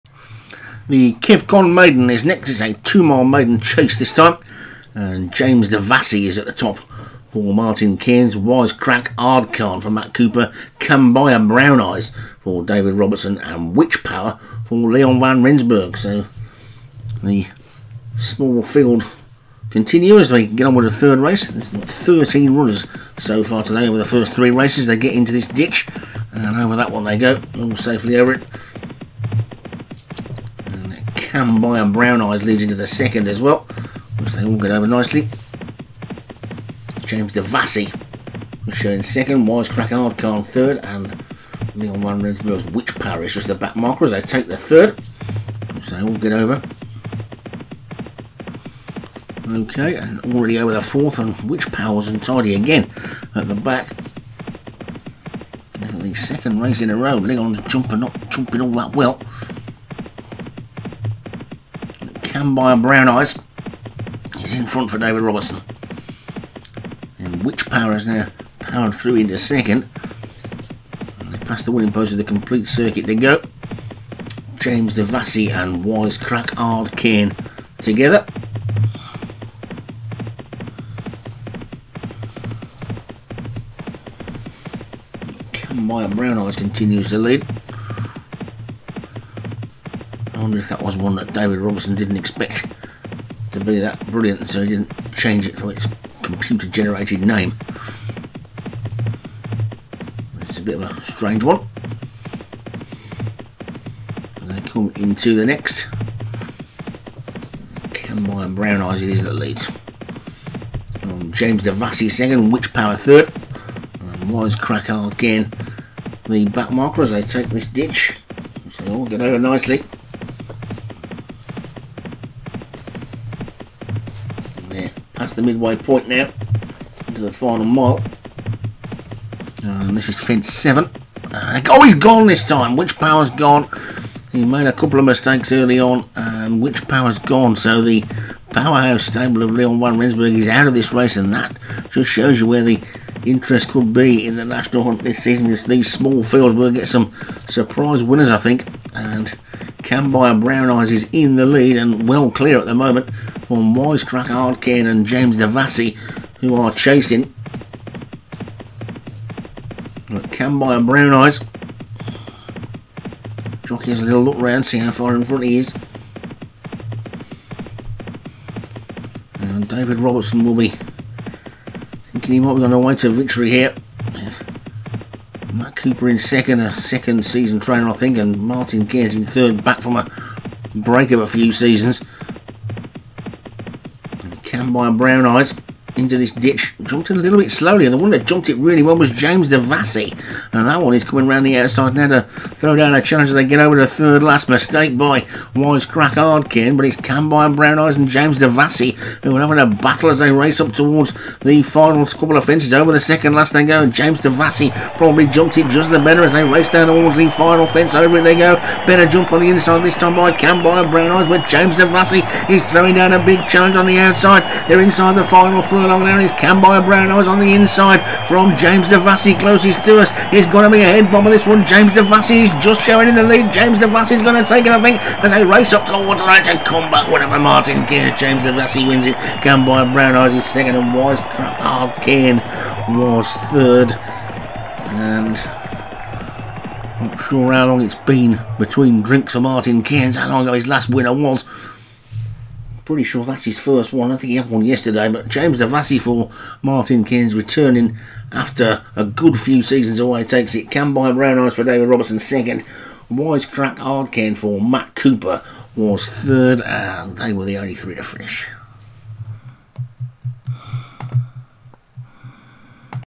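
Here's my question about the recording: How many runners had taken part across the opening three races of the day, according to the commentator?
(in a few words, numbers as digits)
13.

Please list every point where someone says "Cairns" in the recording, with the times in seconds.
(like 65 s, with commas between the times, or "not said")
7 s, 178 s, 227 s, 239 s, 247 s.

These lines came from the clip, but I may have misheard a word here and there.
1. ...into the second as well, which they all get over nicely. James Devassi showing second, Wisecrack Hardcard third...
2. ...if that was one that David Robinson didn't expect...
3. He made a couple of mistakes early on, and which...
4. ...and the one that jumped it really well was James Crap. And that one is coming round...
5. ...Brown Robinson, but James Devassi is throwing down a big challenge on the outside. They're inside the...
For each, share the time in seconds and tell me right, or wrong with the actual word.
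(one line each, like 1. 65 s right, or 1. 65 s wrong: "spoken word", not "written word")
1. 32 s right
2. 90 s right
3. 134 s right
4. 187 s wrong: "Devassi", not "Crap"
5. 210 s wrong: "Eyes", not "Robinson".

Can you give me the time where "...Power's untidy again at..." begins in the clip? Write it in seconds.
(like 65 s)
51 s.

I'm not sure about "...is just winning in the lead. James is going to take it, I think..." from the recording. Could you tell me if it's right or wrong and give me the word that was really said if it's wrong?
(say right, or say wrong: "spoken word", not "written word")
wrong: "showing", not "winning".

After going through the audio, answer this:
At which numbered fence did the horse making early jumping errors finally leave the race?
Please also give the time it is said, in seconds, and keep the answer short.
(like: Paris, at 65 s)
7, at 130 s.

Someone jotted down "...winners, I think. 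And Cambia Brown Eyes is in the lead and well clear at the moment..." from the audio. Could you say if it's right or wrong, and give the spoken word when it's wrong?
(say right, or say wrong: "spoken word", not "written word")
right.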